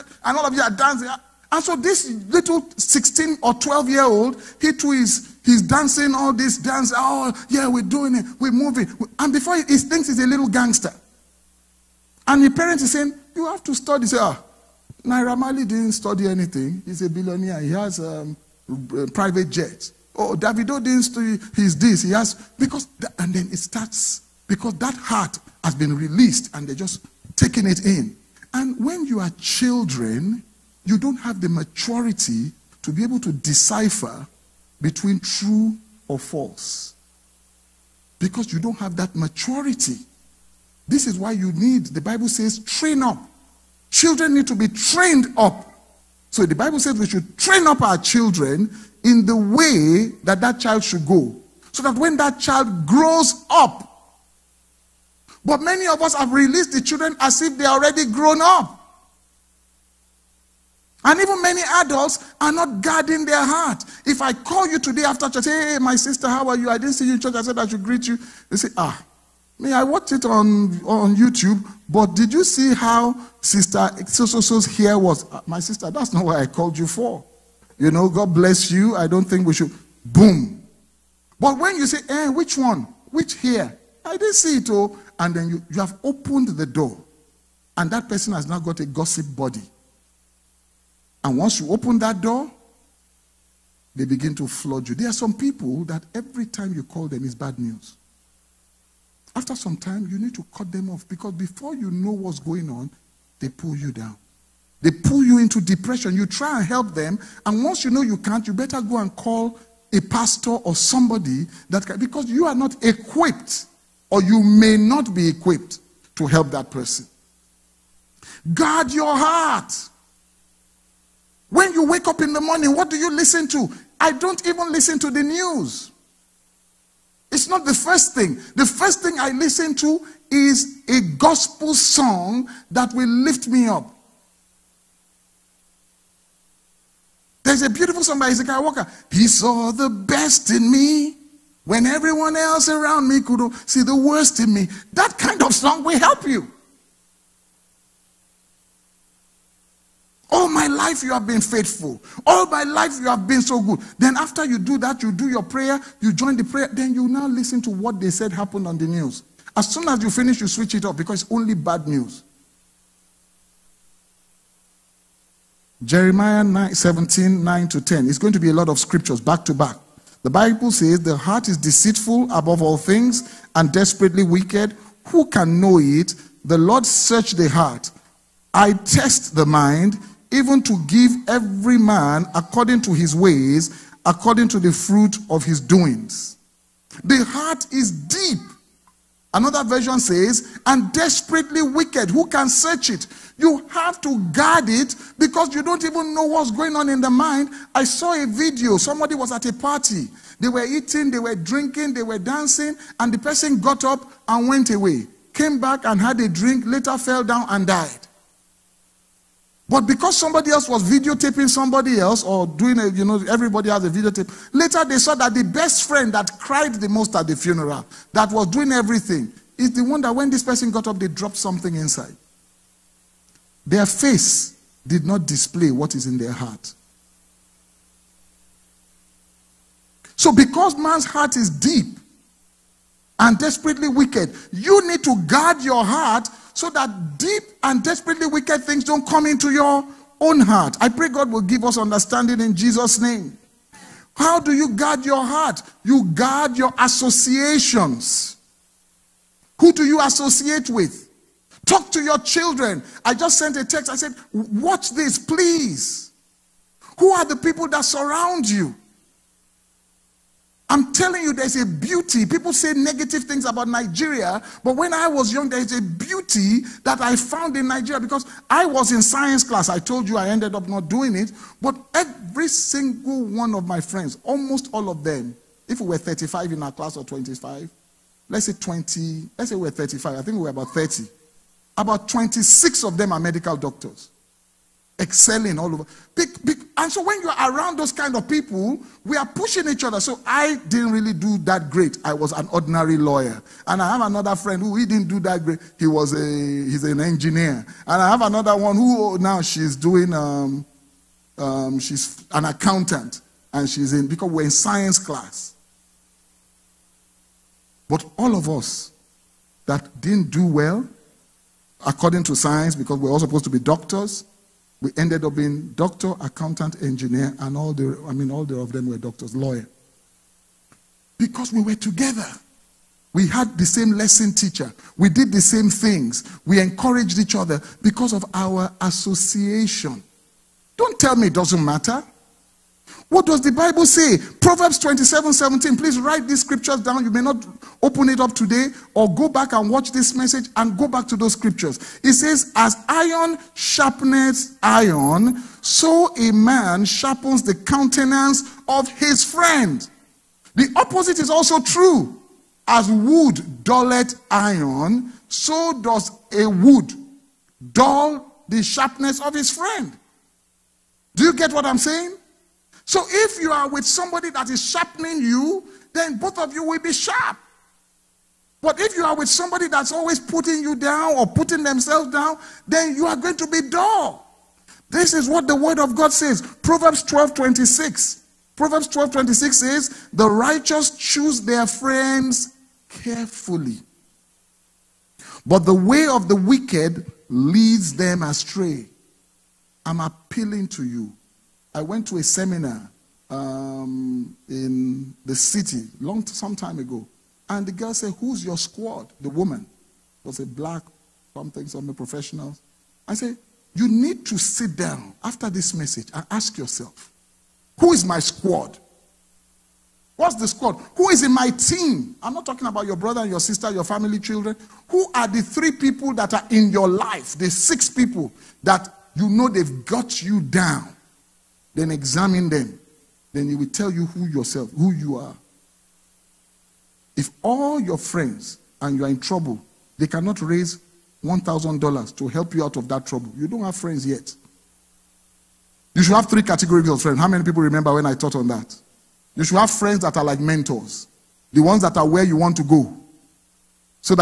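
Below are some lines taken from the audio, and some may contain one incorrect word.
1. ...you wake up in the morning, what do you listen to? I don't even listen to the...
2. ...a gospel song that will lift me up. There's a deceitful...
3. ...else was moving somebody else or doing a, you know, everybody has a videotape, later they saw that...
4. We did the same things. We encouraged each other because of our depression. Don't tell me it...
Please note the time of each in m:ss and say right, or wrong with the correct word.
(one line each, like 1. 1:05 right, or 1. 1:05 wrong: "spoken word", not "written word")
1. 2:01 right
2. 2:10 wrong: "beautiful", not "deceitful"
3. 3:30 wrong: "videotaping", not "moving"
4. 5:24 wrong: "association", not "depression".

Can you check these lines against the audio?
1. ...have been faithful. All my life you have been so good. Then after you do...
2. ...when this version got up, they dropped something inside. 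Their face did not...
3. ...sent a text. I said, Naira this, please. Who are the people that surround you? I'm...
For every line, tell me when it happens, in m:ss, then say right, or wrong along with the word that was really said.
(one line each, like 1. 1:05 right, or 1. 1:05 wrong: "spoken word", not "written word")
1. 2:31 right
2. 3:40 wrong: "person", not "version"
3. 4:13 wrong: "Watch", not "Naira".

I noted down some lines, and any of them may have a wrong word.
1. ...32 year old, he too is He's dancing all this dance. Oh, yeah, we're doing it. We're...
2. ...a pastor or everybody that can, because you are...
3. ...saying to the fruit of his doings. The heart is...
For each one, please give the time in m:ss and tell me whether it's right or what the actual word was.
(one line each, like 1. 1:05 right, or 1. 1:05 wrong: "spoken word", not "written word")
1. 0:03 wrong: "12", not "32"
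2. 1:49 wrong: "somebody", not "everybody"
3. 3:04 wrong: "according", not "saying".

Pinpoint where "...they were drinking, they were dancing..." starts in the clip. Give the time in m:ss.
3:21.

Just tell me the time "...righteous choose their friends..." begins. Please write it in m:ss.
6:20.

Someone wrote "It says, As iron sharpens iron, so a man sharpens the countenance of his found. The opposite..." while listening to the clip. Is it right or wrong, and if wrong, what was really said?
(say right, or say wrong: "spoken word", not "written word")
wrong: "friend", not "found".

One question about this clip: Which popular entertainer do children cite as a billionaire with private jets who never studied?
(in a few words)
Naira Marley.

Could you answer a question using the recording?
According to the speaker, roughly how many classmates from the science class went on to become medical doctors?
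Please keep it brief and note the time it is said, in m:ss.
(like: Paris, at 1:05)
26, at 4:41.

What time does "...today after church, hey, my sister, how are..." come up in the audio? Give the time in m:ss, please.
1:04.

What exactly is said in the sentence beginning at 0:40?
This is why you need, the Bible says, train up.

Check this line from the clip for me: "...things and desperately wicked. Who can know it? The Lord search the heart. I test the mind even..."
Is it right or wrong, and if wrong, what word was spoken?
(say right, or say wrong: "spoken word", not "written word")
right.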